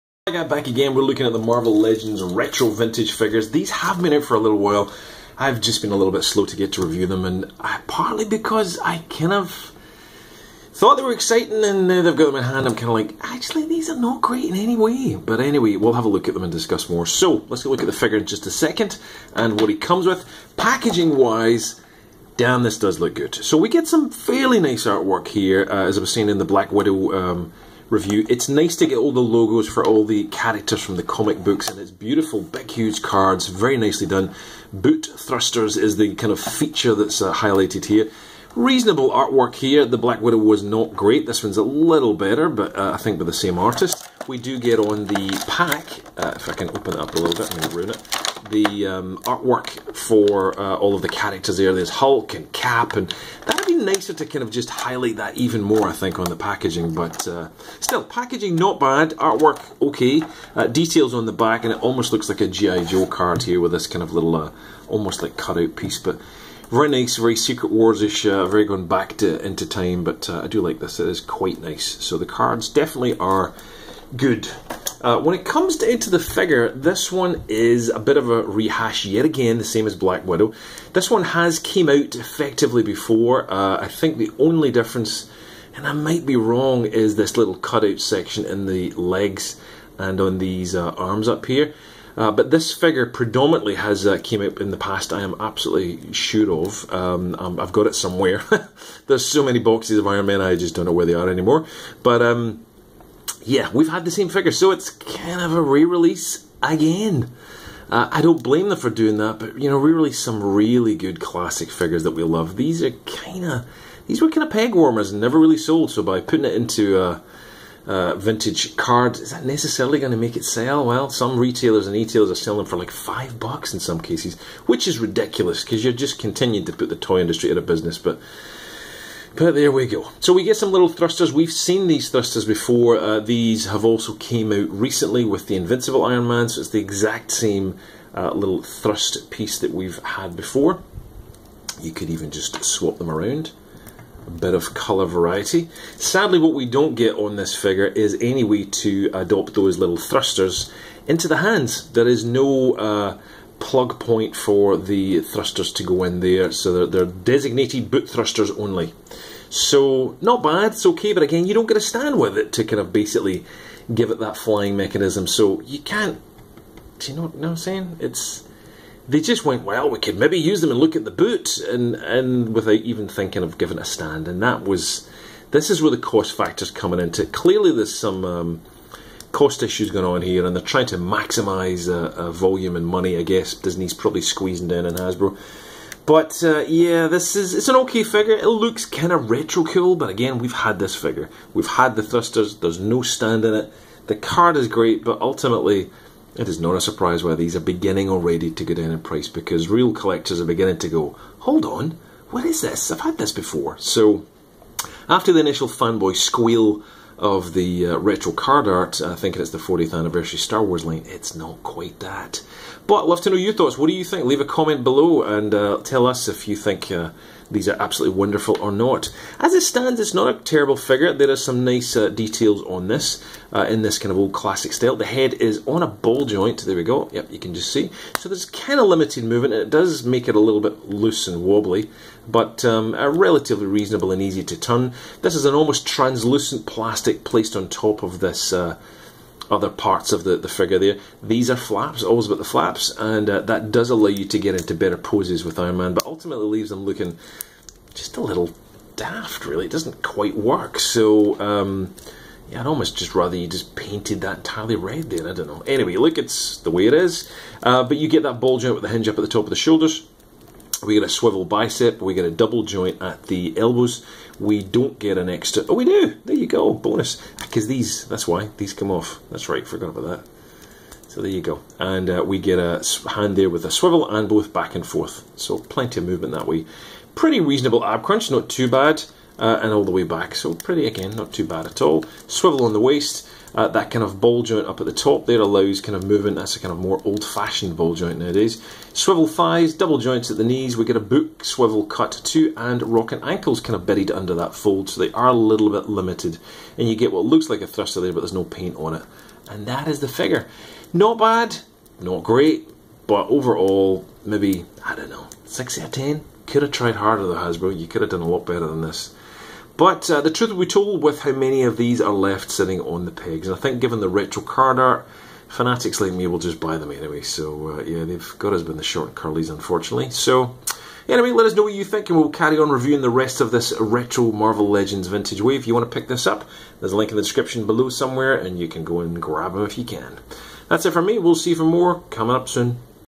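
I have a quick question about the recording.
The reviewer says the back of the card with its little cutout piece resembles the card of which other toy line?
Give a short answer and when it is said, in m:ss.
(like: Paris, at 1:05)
G.I. Joe, at 1:02.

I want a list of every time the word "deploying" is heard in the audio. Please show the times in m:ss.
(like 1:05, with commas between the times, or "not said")
not said.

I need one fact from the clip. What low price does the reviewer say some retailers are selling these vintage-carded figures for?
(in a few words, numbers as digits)
5 bucks.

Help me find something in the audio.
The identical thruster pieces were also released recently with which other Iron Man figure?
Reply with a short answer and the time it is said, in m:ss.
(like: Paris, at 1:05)
Invincible Iron Man, at 2:15.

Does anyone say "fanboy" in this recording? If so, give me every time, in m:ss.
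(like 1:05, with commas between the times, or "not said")
3:25.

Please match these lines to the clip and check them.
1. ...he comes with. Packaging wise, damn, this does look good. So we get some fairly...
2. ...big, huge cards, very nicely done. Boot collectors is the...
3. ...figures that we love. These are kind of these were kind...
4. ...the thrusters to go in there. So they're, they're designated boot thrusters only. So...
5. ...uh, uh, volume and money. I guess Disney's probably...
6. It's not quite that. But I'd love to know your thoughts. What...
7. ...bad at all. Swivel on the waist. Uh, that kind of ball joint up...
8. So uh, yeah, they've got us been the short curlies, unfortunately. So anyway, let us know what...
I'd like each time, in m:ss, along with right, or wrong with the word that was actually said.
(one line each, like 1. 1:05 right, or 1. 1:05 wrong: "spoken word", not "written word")
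1. 0:19 right
2. 0:32 wrong: "thrusters", not "collectors"
3. 1:51 right
4. 2:34 right
5. 3:01 right
6. 3:31 right
7. 4:41 right
8. 5:17 right.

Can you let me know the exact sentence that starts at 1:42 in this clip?
But um, yeah, we've had the same figure, so it's kind of a re-release again.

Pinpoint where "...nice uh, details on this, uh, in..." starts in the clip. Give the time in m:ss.
3:41.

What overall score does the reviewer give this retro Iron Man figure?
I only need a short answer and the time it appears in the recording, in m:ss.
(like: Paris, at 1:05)
6 out of 10, at 5:05.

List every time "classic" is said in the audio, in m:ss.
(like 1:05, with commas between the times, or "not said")
1:51, 3:44.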